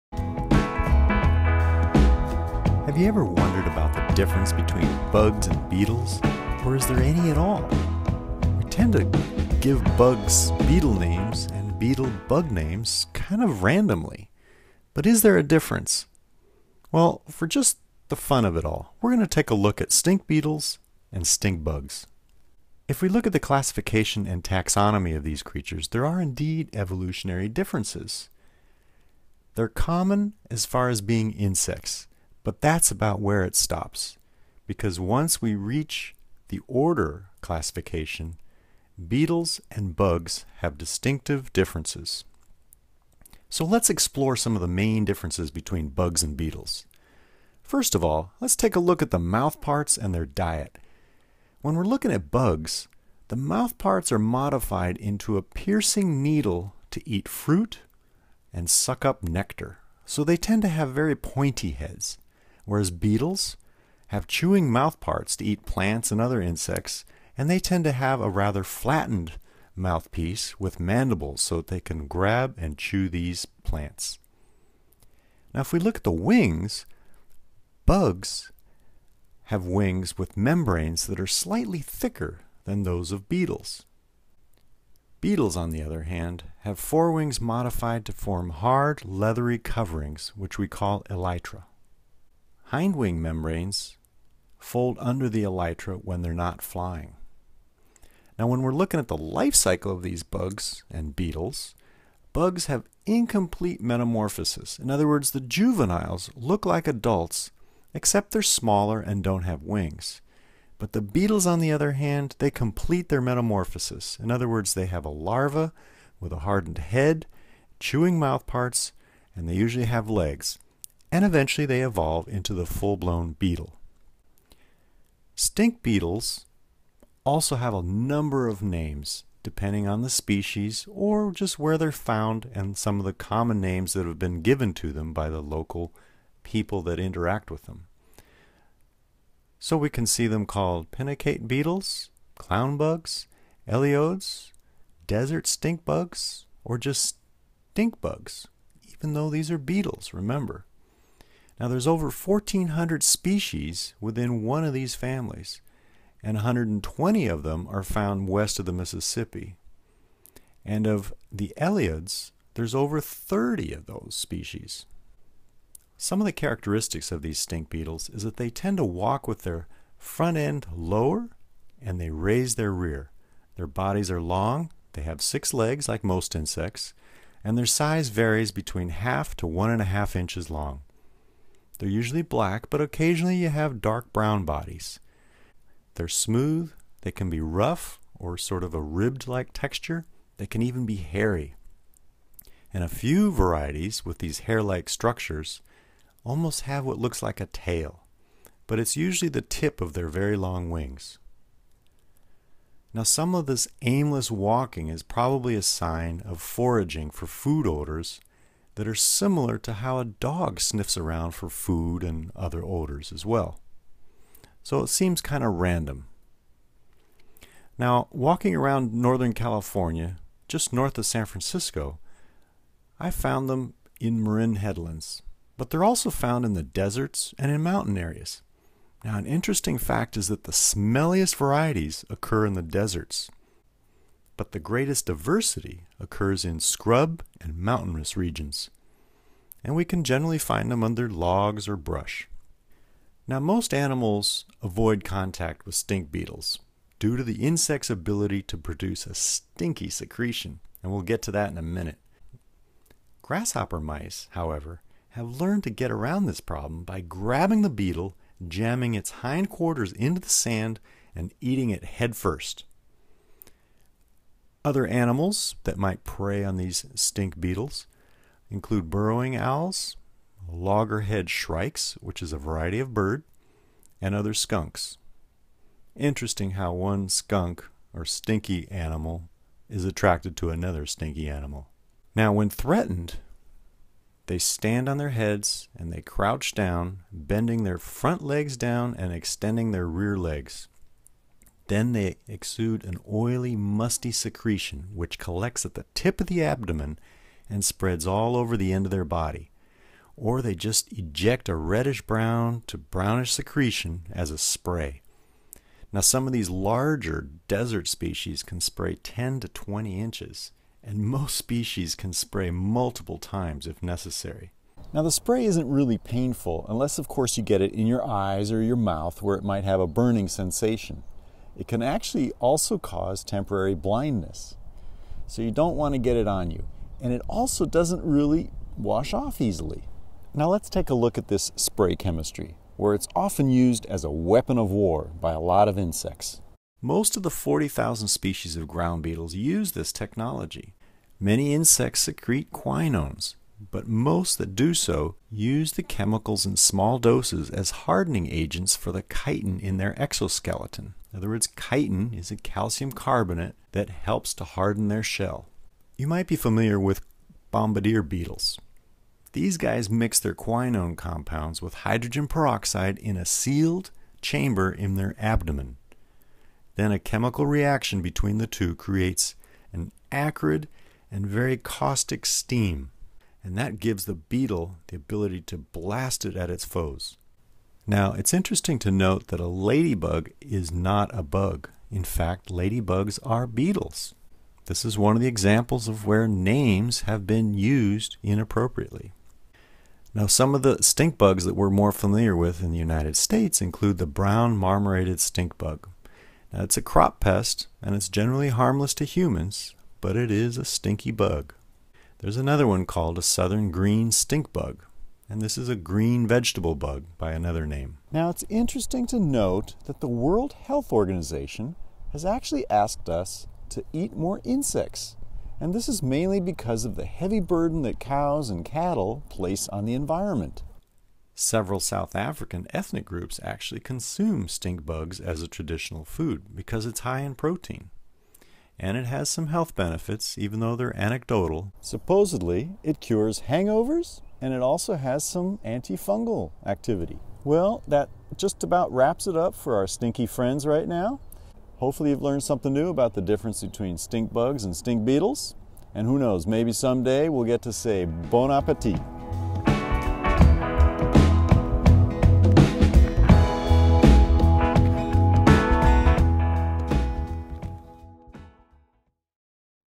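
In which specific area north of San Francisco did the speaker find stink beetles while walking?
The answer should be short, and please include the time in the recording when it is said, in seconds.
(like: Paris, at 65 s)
Marin headlands, at 224 s.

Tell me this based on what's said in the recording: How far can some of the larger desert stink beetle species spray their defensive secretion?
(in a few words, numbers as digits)
10 to 20 inches.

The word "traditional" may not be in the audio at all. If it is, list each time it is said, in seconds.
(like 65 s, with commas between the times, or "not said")
425 s.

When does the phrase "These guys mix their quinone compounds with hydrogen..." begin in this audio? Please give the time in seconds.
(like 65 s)
359 s.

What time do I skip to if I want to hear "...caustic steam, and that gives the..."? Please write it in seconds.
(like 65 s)
371 s.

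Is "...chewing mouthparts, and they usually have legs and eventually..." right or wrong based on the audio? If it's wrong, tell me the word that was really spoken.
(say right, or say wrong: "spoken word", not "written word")
right.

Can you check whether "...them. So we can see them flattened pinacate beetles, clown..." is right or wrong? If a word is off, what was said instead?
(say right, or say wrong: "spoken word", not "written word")
wrong: "called", not "flattened".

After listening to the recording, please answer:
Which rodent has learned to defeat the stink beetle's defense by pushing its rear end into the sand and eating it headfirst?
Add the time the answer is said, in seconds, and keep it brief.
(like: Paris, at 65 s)
Grasshopper mice, at 253 s.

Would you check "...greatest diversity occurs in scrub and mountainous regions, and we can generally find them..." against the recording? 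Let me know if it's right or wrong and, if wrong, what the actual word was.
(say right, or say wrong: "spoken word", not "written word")
right.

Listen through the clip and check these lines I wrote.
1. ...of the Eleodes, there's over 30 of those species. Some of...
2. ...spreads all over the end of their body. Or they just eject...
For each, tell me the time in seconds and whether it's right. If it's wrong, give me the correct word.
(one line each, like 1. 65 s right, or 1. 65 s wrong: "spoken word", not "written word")
1. 160 s right
2. 297 s right.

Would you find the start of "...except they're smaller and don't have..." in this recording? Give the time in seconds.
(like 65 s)
107 s.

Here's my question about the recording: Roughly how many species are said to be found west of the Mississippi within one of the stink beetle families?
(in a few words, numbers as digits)
120.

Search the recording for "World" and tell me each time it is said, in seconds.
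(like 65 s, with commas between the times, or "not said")
410 s.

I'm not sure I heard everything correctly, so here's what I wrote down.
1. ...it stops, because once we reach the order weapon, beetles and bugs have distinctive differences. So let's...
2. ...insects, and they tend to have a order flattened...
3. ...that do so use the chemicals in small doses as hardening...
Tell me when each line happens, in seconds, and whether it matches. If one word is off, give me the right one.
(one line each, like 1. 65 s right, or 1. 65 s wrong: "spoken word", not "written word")
1. 33 s wrong: "classification", not "weapon"
2. 66 s wrong: "rather", not "order"
3. 344 s right.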